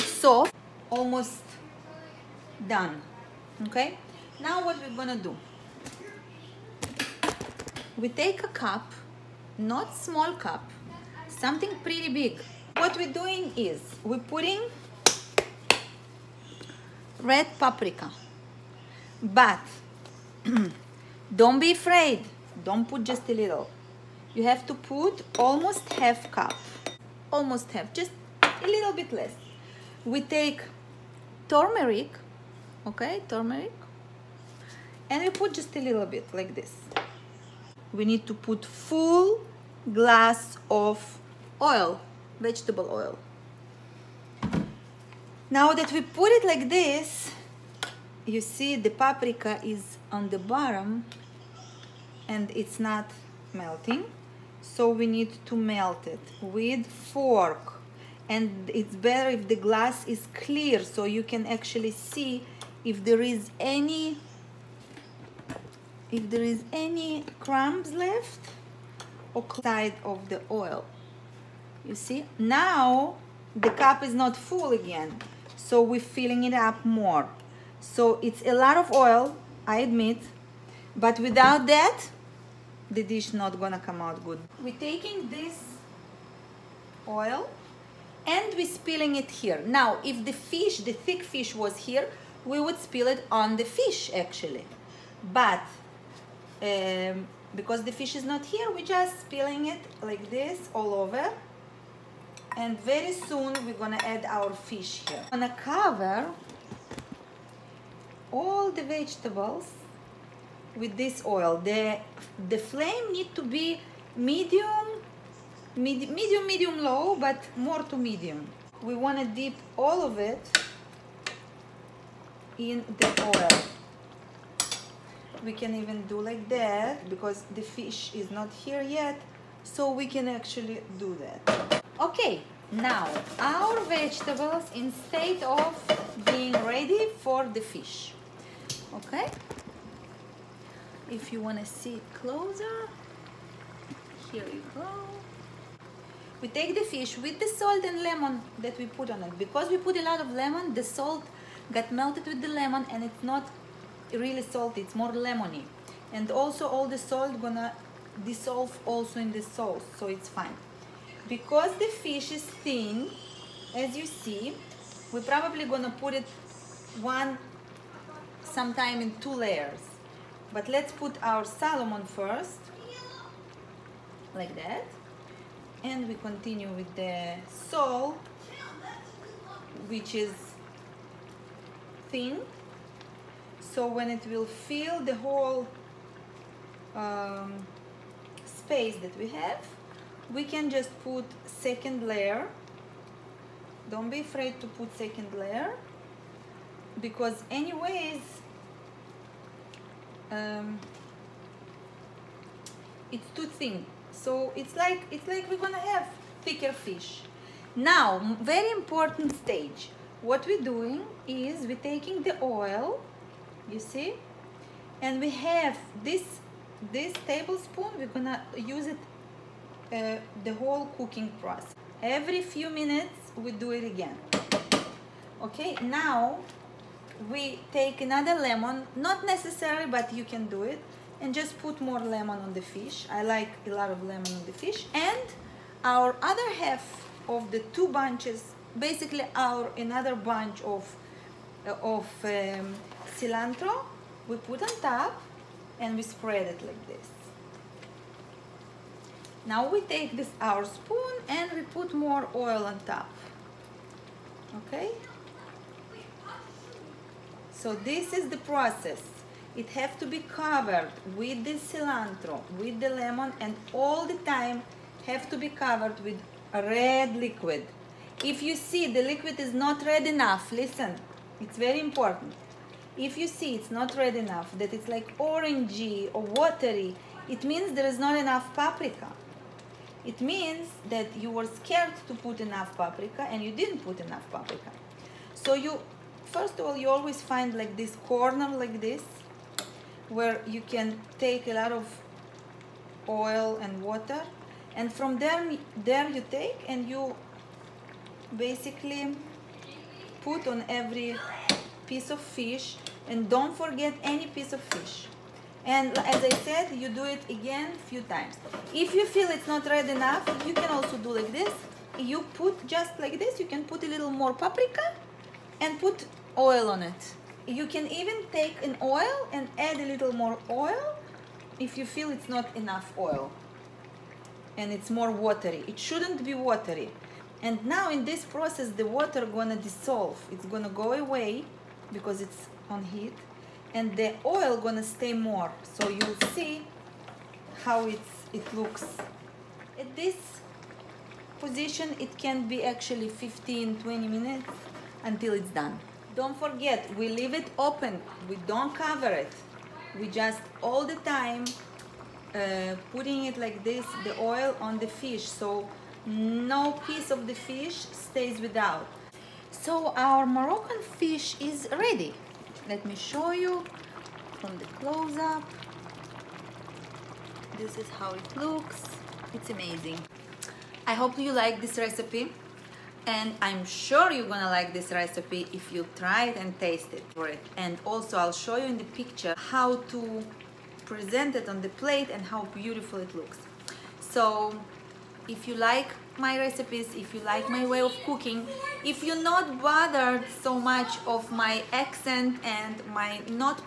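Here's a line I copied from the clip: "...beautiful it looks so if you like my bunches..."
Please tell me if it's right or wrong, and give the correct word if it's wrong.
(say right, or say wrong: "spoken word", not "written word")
wrong: "recipes", not "bunches".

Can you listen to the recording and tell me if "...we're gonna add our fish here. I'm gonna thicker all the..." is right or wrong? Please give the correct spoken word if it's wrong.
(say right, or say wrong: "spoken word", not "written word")
wrong: "cover", not "thicker".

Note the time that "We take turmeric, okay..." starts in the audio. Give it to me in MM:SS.
00:30.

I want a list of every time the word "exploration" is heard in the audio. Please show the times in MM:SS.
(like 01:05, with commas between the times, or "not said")
not said.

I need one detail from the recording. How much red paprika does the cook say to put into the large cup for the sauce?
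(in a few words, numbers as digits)
almost half cup.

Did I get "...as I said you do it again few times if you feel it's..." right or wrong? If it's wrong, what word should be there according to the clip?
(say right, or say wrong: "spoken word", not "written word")
right.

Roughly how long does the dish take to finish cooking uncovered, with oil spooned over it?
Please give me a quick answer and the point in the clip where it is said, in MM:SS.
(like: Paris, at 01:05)
15, 20 minutes, at 05:43.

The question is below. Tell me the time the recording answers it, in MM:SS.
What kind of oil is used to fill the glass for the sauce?
00:42.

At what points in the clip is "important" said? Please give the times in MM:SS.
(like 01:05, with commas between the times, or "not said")
03:28, 04:31.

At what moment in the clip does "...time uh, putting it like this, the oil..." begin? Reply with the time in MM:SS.
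05:50.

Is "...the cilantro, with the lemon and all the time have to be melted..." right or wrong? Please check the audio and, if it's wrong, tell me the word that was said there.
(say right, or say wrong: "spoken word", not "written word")
wrong: "covered", not "melted".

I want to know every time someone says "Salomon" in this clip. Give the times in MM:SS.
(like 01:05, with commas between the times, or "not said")
02:51.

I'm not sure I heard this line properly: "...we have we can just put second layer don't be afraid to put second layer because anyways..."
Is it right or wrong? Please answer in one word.
right.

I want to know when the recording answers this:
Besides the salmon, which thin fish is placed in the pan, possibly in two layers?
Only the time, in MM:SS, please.
02:57.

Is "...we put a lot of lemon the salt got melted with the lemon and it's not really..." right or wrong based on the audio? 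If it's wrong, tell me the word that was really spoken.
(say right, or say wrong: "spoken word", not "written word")
right.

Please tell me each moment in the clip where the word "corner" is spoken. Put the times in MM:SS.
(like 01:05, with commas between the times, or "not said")
04:48.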